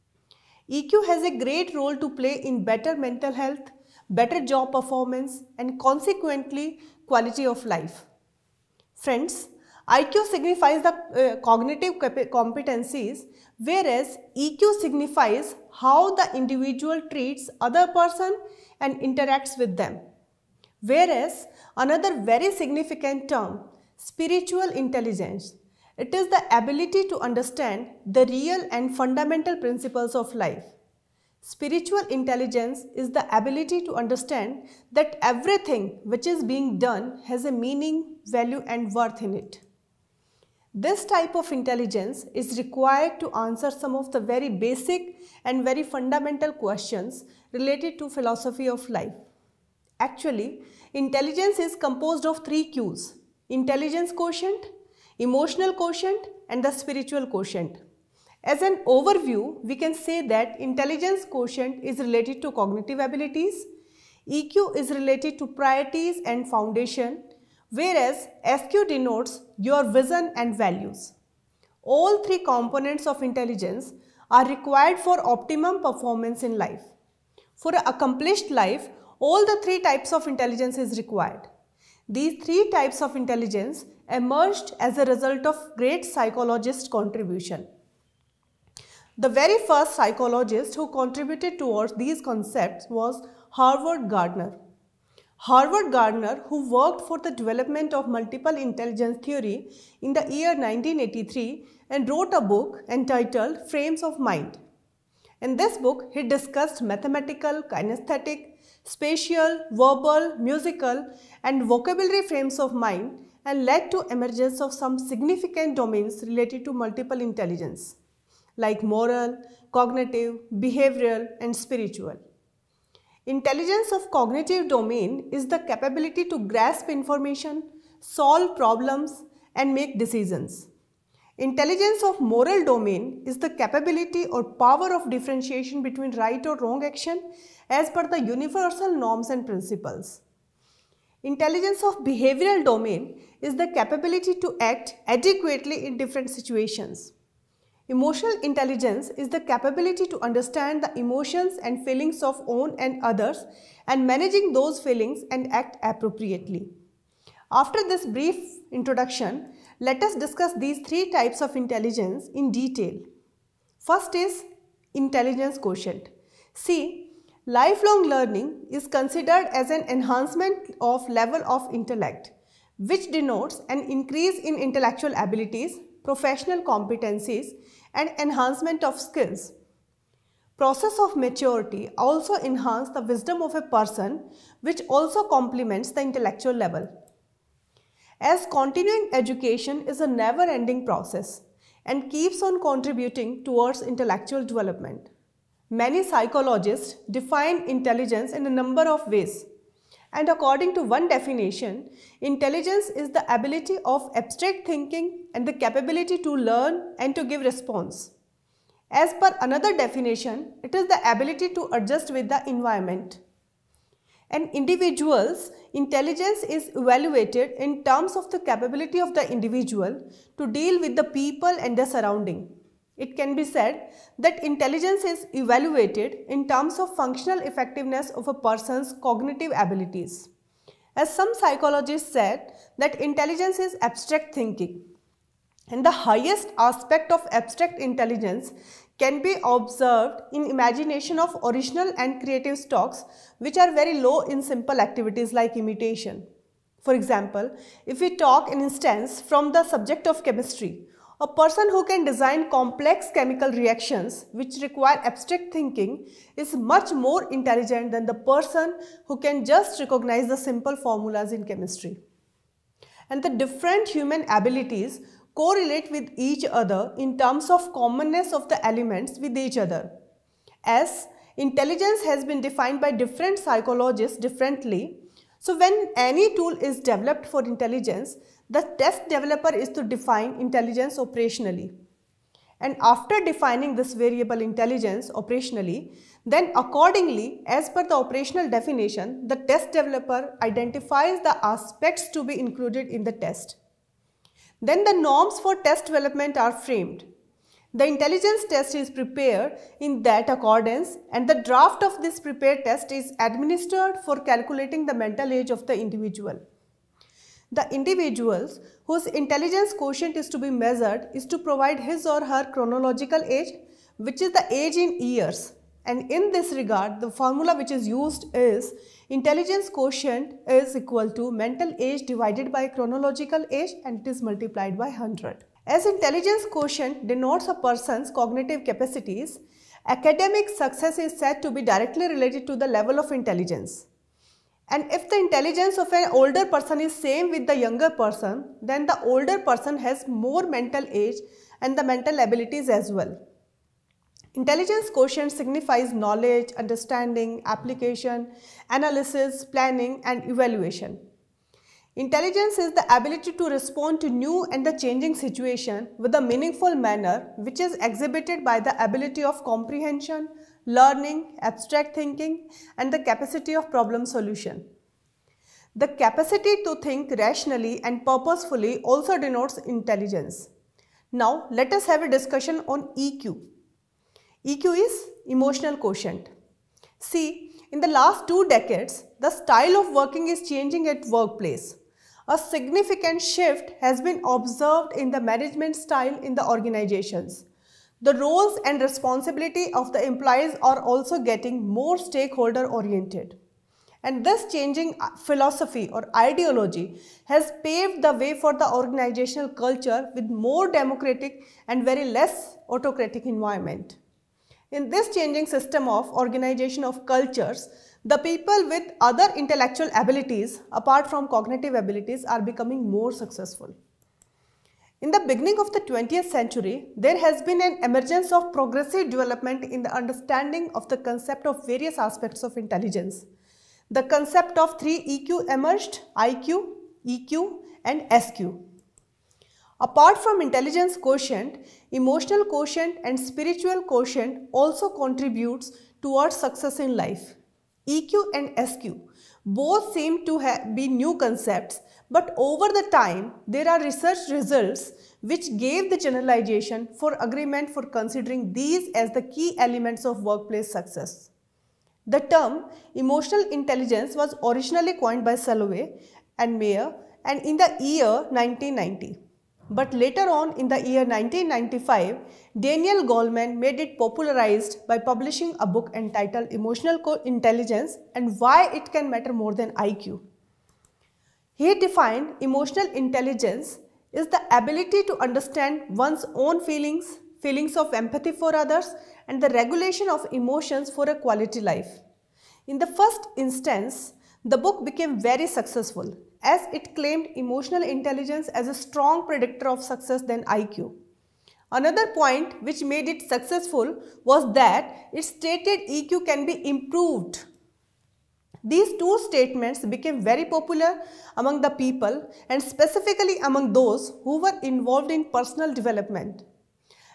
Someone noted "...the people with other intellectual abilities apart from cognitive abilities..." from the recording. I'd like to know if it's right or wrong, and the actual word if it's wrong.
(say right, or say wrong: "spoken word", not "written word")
right.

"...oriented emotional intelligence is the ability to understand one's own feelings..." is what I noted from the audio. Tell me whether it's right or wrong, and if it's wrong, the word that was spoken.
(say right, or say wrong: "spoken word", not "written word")
wrong: "defined", not "oriented".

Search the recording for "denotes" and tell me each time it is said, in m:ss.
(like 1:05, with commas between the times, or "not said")
1:08, 2:53, 5:27, 6:09.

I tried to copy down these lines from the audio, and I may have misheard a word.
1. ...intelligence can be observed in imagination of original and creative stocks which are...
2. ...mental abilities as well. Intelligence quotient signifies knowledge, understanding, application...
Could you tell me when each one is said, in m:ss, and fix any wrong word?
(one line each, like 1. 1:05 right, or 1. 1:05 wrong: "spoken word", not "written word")
1. 3:57 right
2. 5:41 right.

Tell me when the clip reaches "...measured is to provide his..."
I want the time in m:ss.
5:10.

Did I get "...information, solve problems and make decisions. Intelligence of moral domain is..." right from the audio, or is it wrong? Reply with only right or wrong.
right.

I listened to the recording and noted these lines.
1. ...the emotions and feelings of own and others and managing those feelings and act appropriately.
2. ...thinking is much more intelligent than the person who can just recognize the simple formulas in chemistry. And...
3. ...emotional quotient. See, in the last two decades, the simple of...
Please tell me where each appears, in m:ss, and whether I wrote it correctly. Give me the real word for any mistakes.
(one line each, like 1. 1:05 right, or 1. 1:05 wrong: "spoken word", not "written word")
1. 2:30 right
2. 4:15 right
3. 6:15 wrong: "style", not "simple".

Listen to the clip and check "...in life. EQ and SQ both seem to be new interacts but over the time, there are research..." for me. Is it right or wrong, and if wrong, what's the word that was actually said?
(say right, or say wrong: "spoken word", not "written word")
wrong: "concepts", not "interacts".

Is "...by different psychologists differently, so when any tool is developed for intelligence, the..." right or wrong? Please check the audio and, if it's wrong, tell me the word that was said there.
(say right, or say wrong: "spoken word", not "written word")
right.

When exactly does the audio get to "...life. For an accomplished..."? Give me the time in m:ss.
1:16.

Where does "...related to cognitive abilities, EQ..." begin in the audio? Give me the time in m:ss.
1:01.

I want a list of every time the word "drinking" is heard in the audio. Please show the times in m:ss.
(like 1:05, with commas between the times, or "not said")
not said.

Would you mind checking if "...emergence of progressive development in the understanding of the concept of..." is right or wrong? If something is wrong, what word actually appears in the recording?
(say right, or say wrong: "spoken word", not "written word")
right.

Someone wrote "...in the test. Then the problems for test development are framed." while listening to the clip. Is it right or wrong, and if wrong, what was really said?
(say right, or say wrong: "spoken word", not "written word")
wrong: "norms", not "problems".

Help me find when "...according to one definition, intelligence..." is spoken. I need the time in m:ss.
3:20.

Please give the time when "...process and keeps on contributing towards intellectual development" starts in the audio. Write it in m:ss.
3:10.